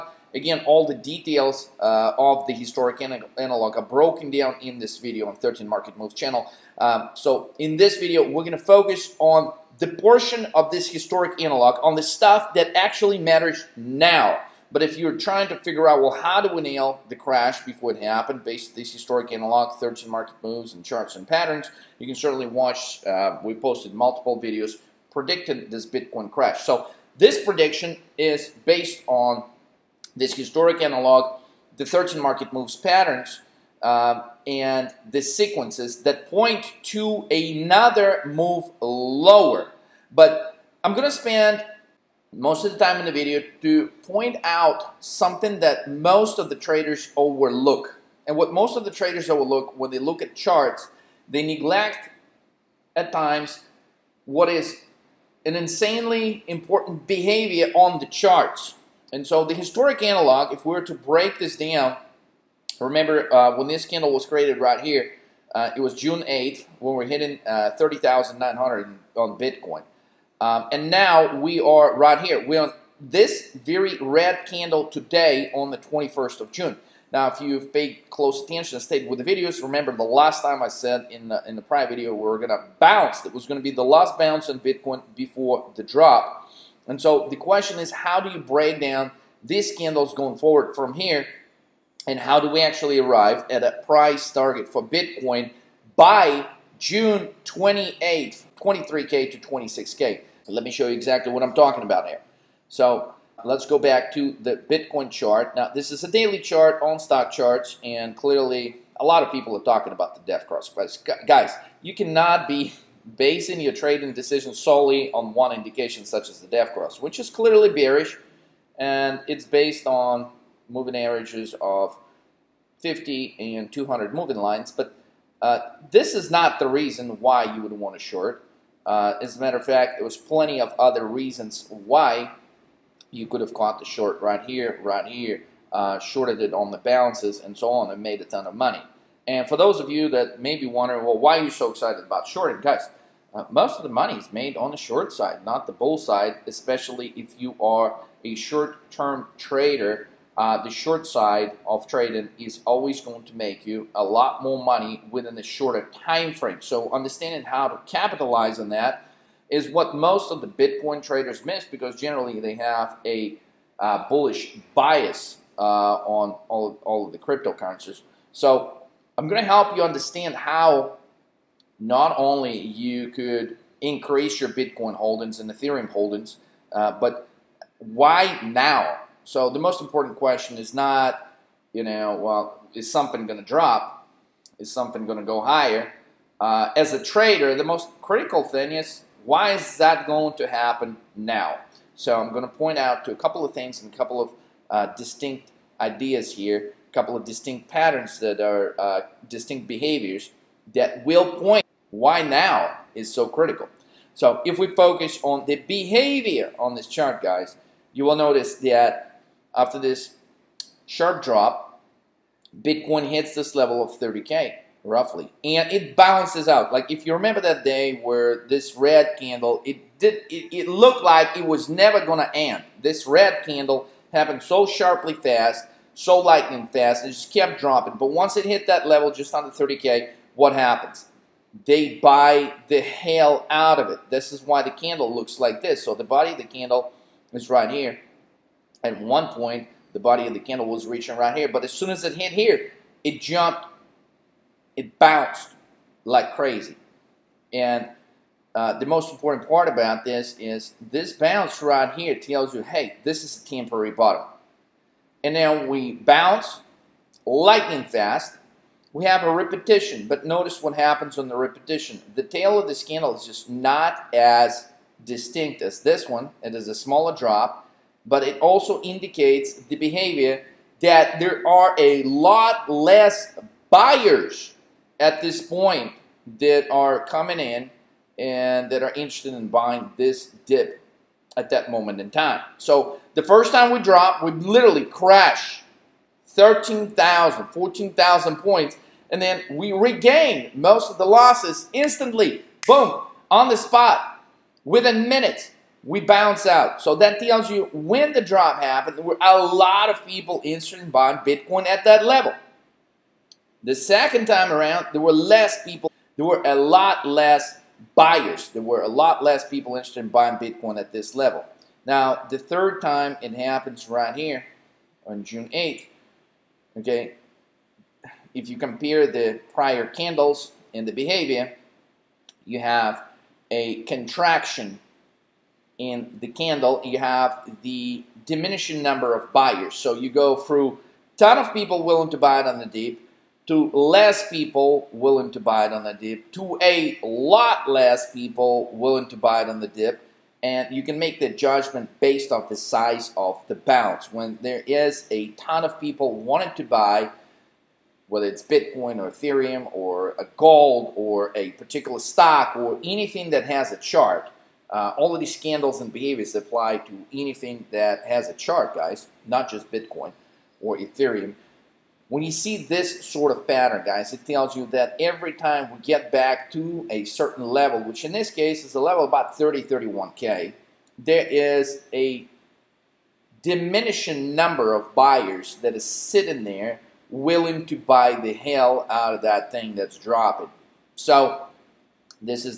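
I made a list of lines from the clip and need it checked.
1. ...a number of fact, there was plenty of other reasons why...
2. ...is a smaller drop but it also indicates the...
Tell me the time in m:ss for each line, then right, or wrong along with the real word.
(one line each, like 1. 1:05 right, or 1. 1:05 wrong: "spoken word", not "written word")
1. 2:09 wrong: "matter", not "number"
2. 4:26 right.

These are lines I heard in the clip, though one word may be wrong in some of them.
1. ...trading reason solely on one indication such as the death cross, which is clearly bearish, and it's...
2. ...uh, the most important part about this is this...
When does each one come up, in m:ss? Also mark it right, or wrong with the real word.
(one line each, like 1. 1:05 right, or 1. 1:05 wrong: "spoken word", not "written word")
1. 1:53 wrong: "decision", not "reason"
2. 4:08 right.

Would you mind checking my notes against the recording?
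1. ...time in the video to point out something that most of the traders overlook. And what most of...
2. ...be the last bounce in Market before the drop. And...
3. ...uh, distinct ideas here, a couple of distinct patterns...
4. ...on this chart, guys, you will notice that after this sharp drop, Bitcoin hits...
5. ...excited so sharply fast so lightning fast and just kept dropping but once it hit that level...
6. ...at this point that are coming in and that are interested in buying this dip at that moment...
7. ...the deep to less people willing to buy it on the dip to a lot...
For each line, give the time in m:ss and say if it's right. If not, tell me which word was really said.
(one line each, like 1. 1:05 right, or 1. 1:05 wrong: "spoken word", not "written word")
1. 0:42 right
2. 1:23 wrong: "Bitcoin", not "Market"
3. 3:14 right
4. 3:26 right
5. 3:44 wrong: "happened", not "excited"
6. 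4:34 right
7. 5:32 right.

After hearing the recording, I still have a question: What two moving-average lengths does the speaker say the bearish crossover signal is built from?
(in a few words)
50 and 200.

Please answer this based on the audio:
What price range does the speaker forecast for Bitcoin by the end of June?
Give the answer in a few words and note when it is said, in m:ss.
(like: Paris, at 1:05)
23K to 26K, at 1:38.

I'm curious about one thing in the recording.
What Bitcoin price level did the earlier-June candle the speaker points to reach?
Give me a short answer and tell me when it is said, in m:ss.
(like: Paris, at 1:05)
30,900, at 1:07.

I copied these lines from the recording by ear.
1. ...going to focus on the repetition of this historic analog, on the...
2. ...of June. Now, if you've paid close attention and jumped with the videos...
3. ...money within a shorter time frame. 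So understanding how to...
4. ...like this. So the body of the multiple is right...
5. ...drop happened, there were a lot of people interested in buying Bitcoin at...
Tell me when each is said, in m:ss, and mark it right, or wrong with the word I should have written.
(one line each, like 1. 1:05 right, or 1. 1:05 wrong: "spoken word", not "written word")
1. 0:08 wrong: "portion", not "repetition"
2. 1:16 wrong: "stayed", not "jumped"
3. 2:34 right
4. 3:55 wrong: "candle", not "multiple"
5. 4:58 right.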